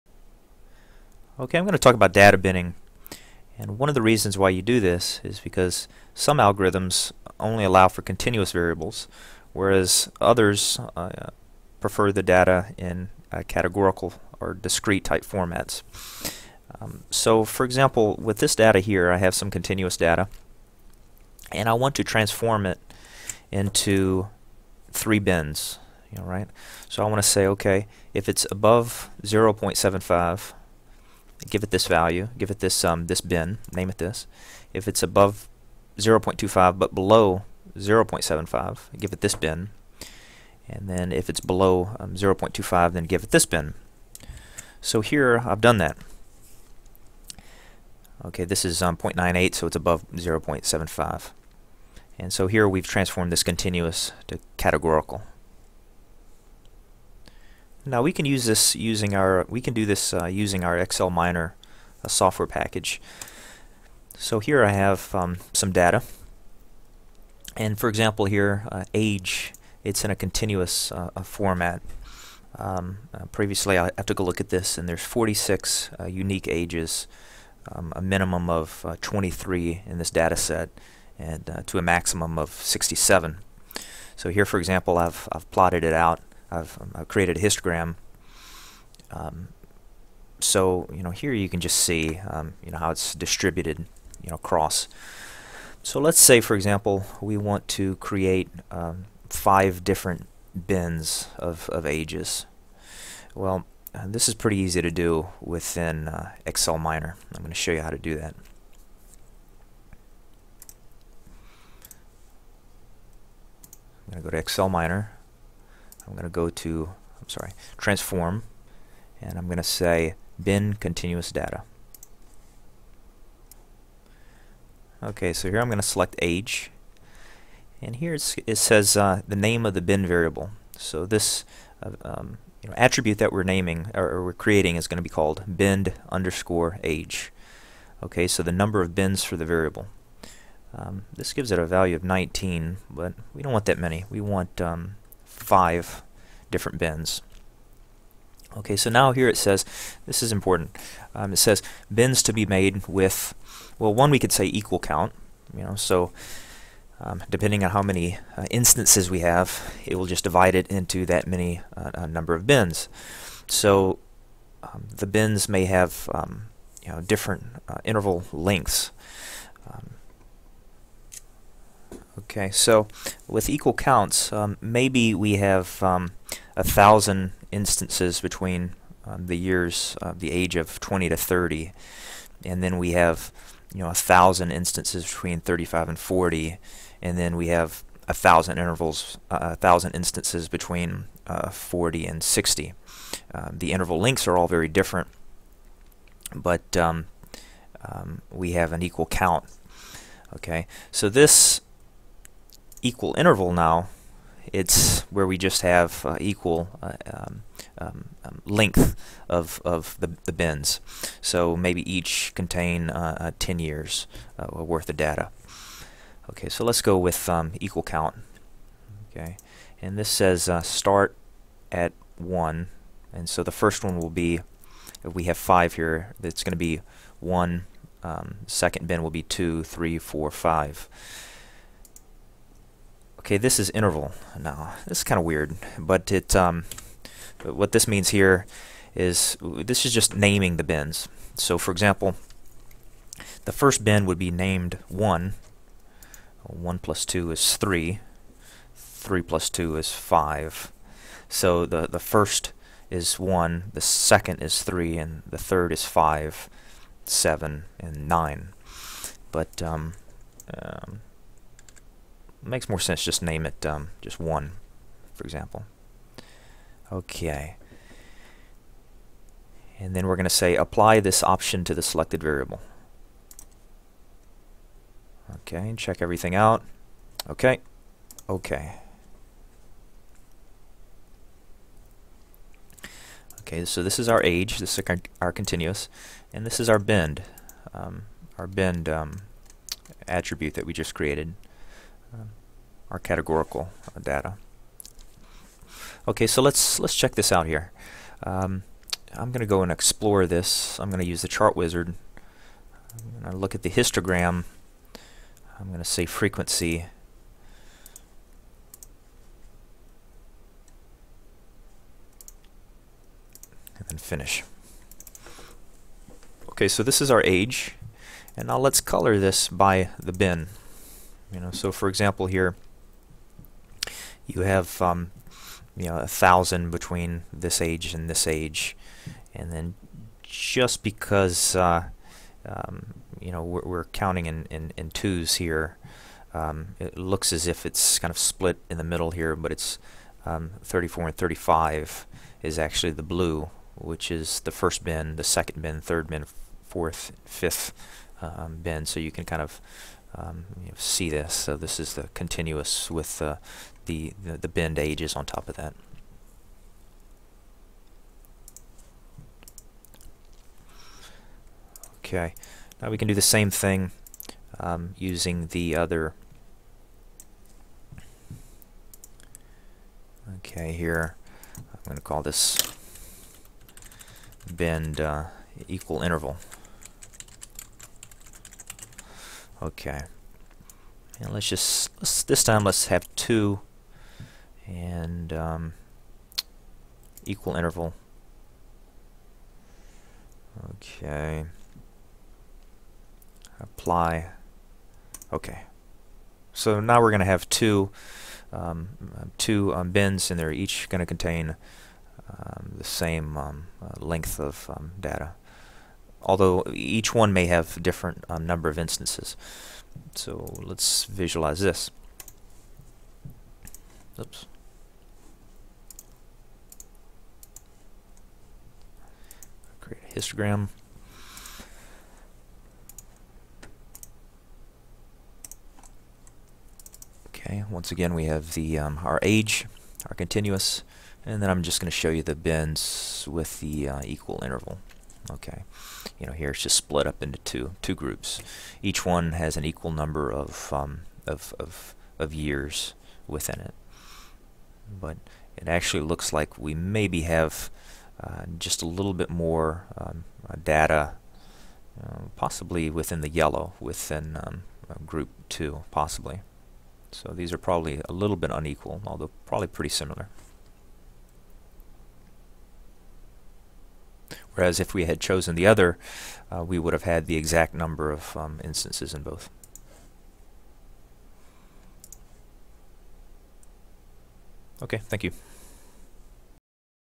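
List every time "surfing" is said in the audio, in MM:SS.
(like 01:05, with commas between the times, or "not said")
not said.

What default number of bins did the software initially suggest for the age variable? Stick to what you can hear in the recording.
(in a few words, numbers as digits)
19.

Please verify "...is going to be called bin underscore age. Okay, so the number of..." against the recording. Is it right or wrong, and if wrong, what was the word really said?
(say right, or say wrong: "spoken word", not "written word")
right.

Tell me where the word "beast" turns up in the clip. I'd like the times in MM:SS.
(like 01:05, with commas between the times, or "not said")
not said.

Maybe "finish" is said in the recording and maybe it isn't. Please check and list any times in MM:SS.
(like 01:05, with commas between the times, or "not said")
05:13.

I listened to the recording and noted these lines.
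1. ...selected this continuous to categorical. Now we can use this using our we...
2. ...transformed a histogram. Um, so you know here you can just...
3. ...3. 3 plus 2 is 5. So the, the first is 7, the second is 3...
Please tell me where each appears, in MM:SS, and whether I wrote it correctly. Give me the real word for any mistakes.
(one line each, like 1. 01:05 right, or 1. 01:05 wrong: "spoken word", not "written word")
1. 00:52 wrong: "transformed", not "selected"
2. 01:27 wrong: "created", not "transformed"
3. 04:07 wrong: "1", not "7".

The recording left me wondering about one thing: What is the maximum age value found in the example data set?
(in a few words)
67.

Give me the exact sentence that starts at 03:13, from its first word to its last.
Um, the interval lengths are all very different, but um, um, we have an equal count.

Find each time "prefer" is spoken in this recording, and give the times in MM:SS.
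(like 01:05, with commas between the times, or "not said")
00:11.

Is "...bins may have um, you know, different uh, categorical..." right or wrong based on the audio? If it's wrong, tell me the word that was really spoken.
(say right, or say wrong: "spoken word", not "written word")
wrong: "interval", not "categorical".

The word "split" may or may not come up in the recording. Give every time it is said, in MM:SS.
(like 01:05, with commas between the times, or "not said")
05:38, 07:16.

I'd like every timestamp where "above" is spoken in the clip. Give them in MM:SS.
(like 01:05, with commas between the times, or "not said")
00:28, 00:35, 00:49.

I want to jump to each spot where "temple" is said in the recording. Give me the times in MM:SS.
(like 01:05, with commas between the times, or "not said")
not said.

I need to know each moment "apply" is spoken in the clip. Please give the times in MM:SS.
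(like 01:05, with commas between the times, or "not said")
04:30, 06:33.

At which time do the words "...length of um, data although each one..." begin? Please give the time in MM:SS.
06:44.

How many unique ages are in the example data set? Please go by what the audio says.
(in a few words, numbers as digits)
46.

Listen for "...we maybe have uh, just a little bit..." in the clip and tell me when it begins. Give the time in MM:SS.
07:26.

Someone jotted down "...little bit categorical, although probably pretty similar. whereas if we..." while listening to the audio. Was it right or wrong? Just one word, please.
wrong.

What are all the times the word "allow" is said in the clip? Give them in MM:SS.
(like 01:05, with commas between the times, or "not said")
00:07.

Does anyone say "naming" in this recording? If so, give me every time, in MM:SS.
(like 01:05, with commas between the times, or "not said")
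02:13, 04:00.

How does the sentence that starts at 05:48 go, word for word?
So you can kind of um, you know, see this.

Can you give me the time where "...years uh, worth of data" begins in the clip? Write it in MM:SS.
03:33.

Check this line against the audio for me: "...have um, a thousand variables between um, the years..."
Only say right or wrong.
wrong.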